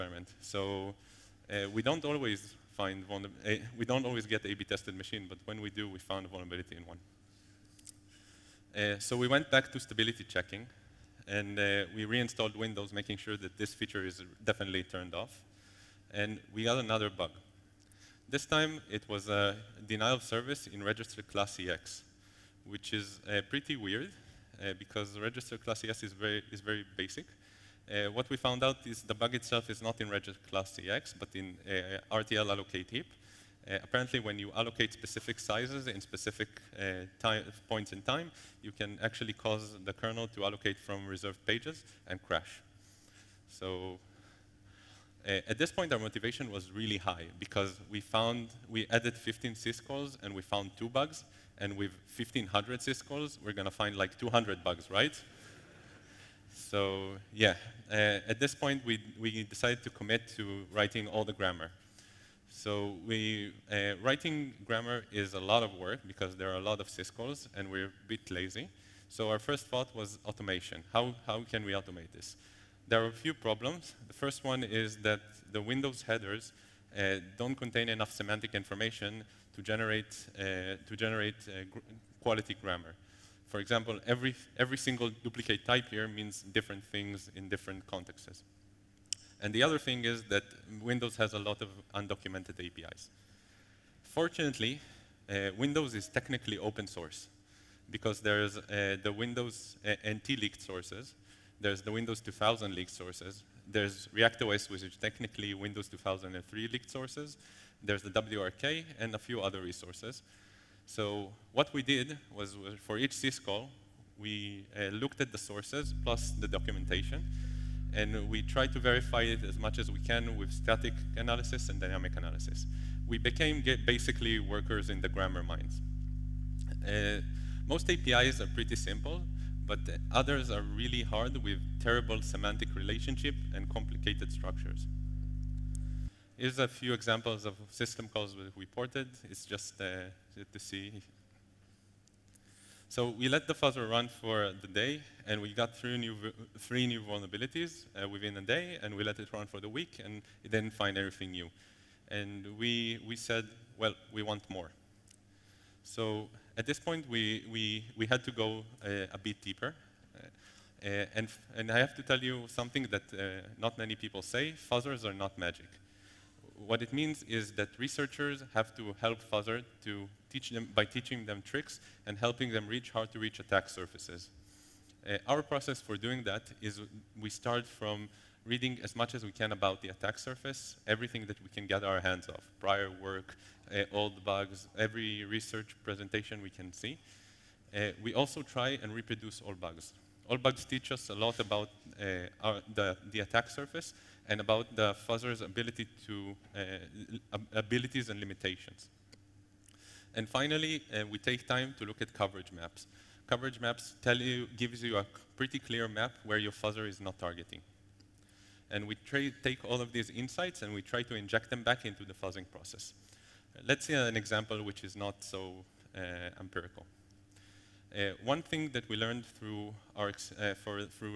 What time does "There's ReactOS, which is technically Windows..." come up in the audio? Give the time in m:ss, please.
1:43.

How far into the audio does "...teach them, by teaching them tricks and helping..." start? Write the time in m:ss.
2:50.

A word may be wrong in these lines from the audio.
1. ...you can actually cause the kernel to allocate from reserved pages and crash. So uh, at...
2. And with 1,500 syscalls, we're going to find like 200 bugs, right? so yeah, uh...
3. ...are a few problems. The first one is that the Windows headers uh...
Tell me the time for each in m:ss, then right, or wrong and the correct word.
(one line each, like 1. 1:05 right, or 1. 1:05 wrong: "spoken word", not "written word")
1. 0:38 right
2. 0:51 right
3. 1:13 right.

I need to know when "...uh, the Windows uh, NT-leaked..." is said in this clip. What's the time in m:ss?
1:38.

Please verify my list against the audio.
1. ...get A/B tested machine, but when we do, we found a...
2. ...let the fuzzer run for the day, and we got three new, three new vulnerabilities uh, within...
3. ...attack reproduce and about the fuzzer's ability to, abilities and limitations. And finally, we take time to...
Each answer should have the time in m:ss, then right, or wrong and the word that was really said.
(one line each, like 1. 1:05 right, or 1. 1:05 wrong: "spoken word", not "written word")
1. 0:04 right
2. 2:23 right
3. 3:13 wrong: "surface", not "reproduce".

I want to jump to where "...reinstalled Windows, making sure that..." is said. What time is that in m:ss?
0:12.